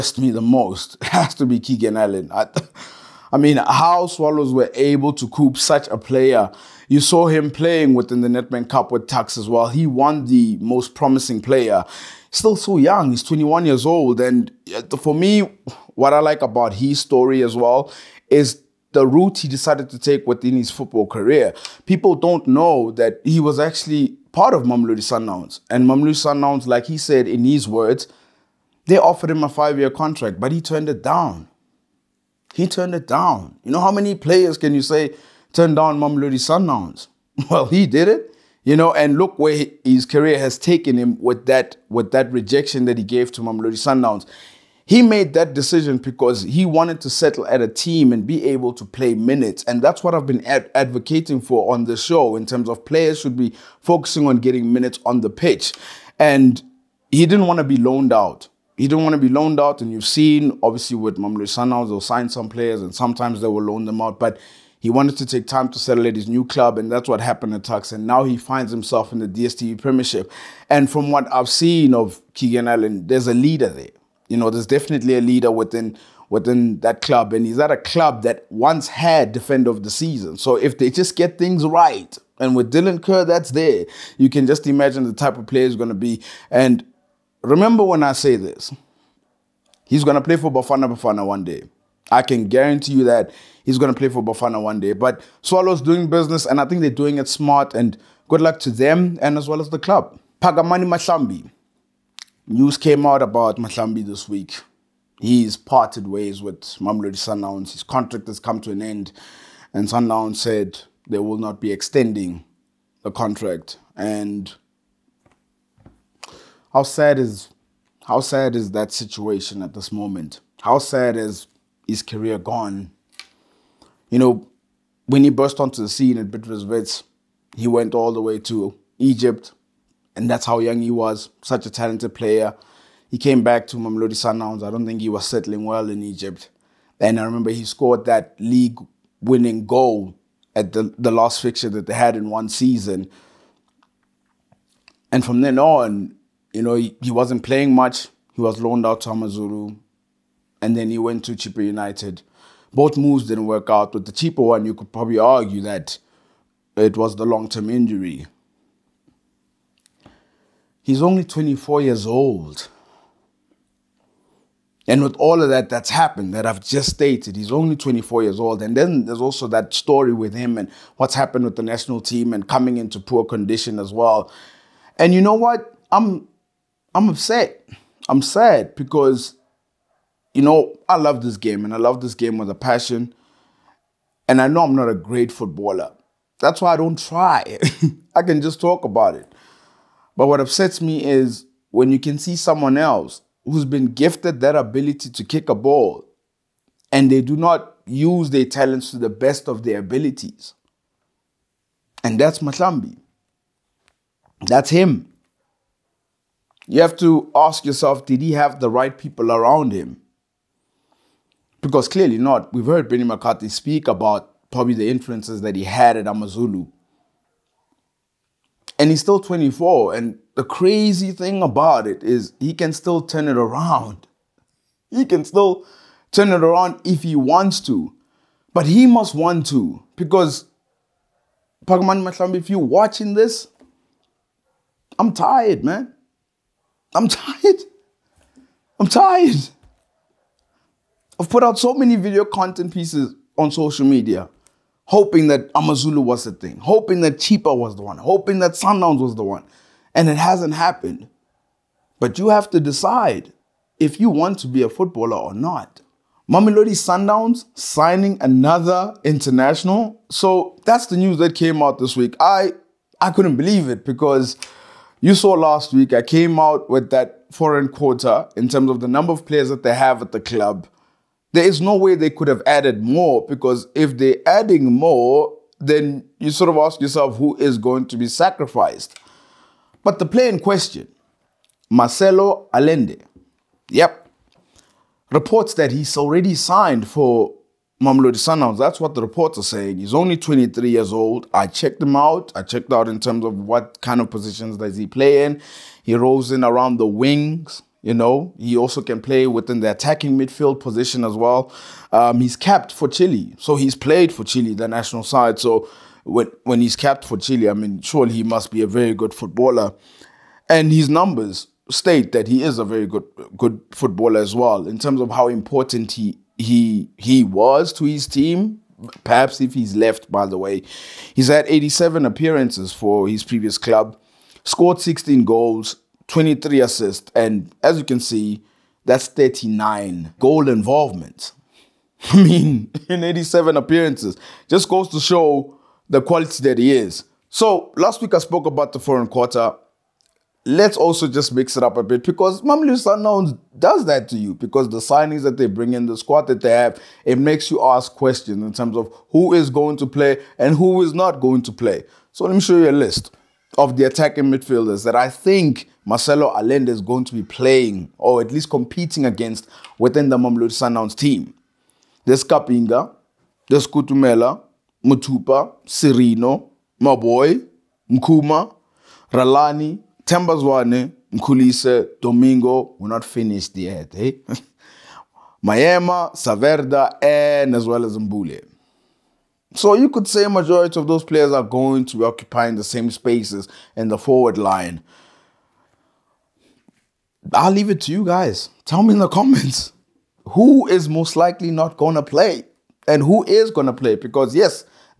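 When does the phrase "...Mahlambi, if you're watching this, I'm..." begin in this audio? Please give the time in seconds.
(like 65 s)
232 s.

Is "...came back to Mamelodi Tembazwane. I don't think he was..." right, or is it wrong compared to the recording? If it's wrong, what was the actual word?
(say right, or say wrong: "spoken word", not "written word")
wrong: "Sundowns", not "Tembazwane".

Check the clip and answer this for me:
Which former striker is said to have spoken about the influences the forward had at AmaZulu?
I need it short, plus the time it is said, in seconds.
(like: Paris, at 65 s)
Benny McCarthy, at 212 s.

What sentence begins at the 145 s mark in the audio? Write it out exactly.
And from then on, you know, he, he wasn't playing much.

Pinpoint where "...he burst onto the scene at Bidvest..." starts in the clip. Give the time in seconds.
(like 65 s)
125 s.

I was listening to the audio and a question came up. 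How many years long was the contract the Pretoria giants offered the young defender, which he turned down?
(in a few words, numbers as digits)
5.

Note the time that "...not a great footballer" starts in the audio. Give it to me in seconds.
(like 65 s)
184 s.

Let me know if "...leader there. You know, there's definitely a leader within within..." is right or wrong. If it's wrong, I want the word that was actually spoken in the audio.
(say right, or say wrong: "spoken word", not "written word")
right.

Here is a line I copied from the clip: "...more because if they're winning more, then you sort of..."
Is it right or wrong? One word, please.
wrong.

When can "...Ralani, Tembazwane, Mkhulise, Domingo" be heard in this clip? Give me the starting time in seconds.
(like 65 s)
369 s.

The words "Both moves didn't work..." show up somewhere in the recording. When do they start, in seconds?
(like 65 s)
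152 s.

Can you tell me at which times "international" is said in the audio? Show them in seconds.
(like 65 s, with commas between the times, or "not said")
259 s.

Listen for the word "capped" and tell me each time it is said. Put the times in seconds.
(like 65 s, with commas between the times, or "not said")
302 s, 306 s.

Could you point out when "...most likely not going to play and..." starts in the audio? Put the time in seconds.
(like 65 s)
390 s.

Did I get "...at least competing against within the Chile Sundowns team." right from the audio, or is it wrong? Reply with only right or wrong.
wrong.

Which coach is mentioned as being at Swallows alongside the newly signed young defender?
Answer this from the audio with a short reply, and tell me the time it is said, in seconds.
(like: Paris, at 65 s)
Dylan Kerr, at 82 s.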